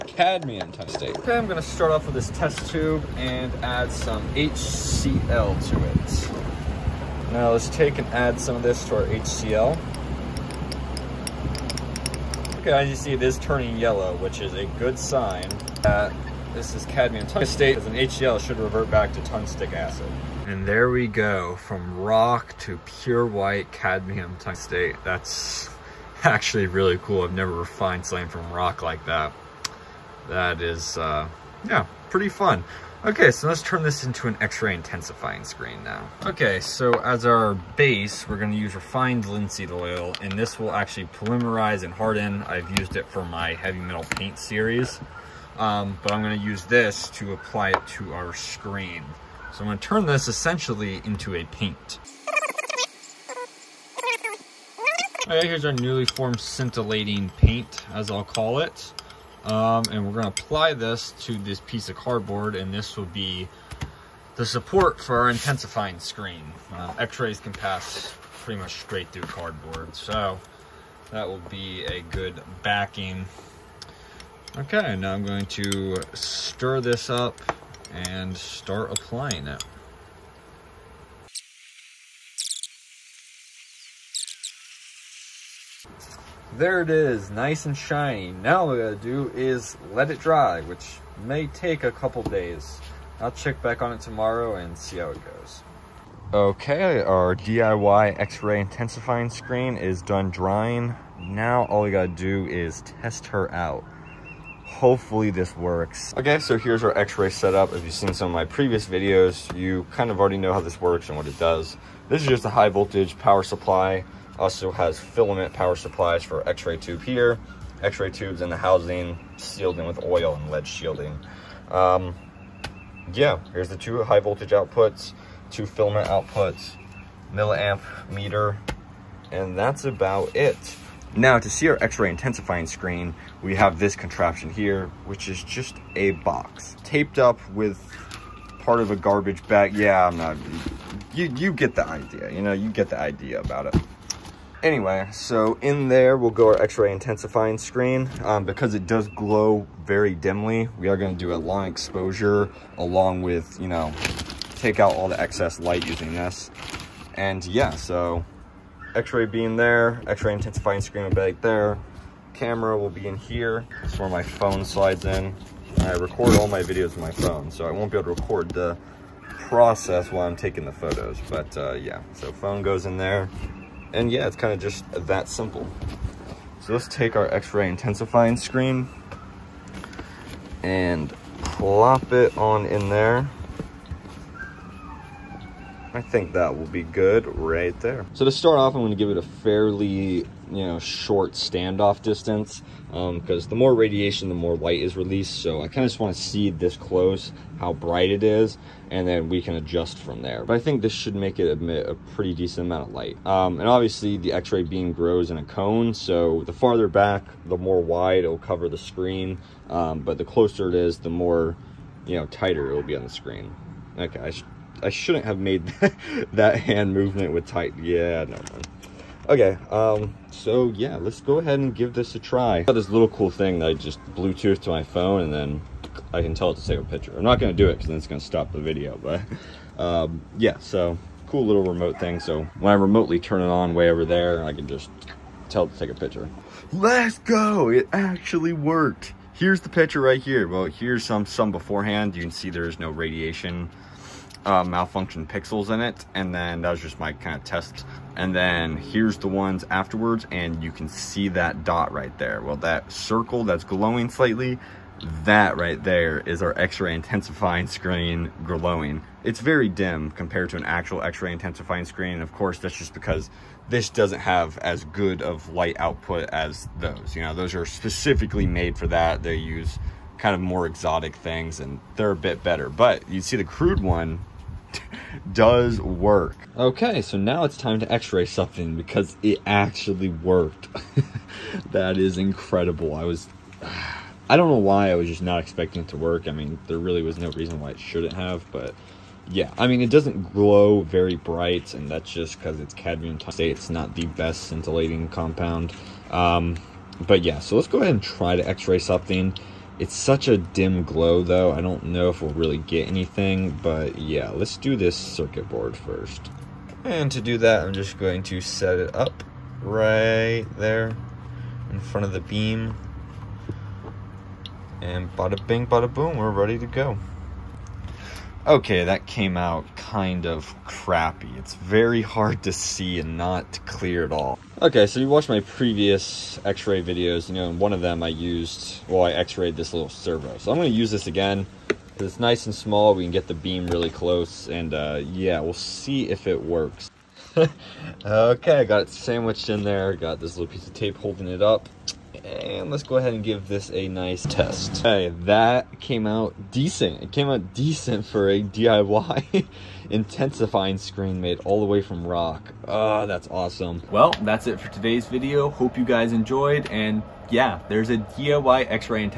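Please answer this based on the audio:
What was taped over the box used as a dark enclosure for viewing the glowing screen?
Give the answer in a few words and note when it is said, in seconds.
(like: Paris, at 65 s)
Part of a garbage bag, at 138 s.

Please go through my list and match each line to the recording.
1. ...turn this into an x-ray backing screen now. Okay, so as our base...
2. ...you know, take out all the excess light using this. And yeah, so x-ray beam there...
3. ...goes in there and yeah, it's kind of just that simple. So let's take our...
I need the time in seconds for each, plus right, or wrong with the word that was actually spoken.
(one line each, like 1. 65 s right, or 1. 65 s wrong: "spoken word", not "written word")
1. 33 s wrong: "intensifying", not "backing"
2. 153 s right
3. 172 s right.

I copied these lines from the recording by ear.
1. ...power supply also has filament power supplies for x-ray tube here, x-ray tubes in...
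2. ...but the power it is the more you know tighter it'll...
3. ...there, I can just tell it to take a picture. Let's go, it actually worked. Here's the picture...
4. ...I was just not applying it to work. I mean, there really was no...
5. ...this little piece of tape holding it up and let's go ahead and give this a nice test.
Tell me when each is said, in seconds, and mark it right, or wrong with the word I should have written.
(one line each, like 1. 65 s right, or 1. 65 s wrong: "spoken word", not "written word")
1. 113 s right
2. 209 s wrong: "closer", not "power"
3. 234 s right
4. 284 s wrong: "expecting", not "applying"
5. 340 s right.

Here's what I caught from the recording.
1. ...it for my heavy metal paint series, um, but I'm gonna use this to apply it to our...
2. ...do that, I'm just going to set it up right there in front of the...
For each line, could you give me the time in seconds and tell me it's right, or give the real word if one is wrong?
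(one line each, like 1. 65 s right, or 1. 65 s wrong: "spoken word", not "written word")
1. 42 s right
2. 307 s right.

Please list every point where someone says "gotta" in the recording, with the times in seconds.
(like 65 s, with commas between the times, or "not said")
88 s, 101 s.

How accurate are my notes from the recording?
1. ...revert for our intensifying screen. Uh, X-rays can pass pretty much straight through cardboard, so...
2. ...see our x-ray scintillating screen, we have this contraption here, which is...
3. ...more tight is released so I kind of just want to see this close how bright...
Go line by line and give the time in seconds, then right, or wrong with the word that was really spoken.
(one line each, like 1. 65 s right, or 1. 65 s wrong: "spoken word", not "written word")
1. 64 s wrong: "support", not "revert"
2. 131 s wrong: "intensifying", not "scintillating"
3. 194 s wrong: "light", not "tight".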